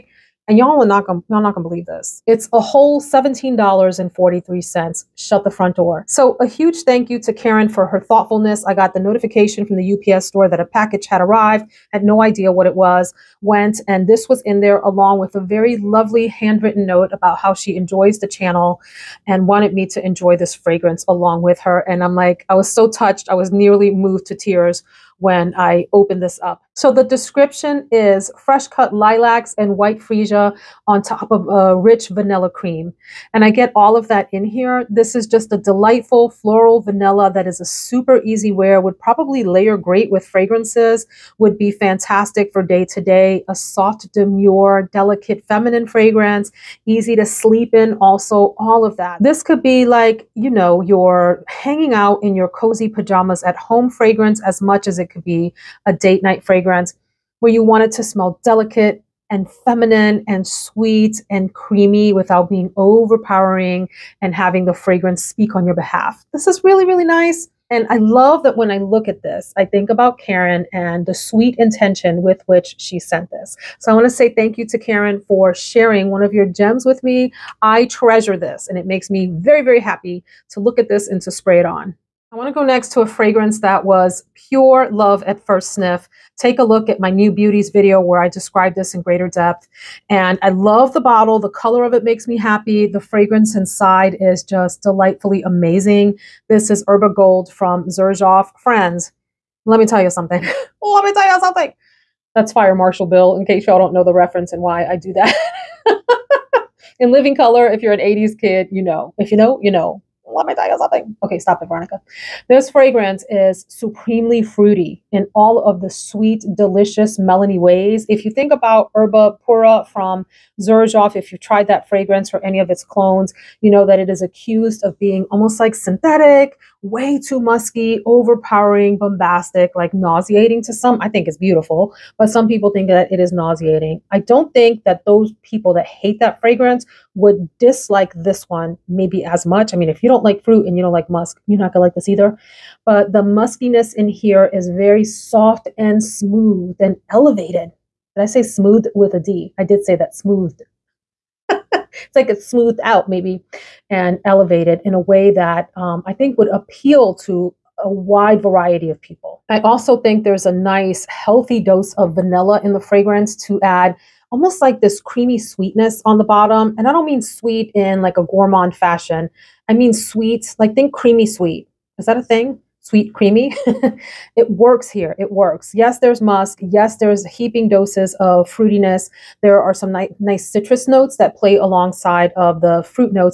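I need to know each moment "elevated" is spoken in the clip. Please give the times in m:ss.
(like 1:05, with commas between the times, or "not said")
2:27, 2:34.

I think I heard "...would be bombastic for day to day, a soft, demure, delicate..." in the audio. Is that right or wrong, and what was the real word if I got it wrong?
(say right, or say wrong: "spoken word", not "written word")
wrong: "fantastic", not "bombastic".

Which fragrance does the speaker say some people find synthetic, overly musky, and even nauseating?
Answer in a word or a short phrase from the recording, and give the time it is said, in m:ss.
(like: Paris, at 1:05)
Erba Pura, at 1:58.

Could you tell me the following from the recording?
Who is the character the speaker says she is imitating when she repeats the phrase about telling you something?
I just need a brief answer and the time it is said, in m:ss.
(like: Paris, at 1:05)
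Fire Marshal Bill, at 1:42.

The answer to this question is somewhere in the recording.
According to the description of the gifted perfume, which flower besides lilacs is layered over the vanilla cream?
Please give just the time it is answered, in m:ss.
0:29.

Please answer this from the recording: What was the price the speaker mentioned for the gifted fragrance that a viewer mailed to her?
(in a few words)
$17.43.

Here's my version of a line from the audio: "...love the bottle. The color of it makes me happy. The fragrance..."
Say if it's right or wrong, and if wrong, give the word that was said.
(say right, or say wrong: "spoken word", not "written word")
right.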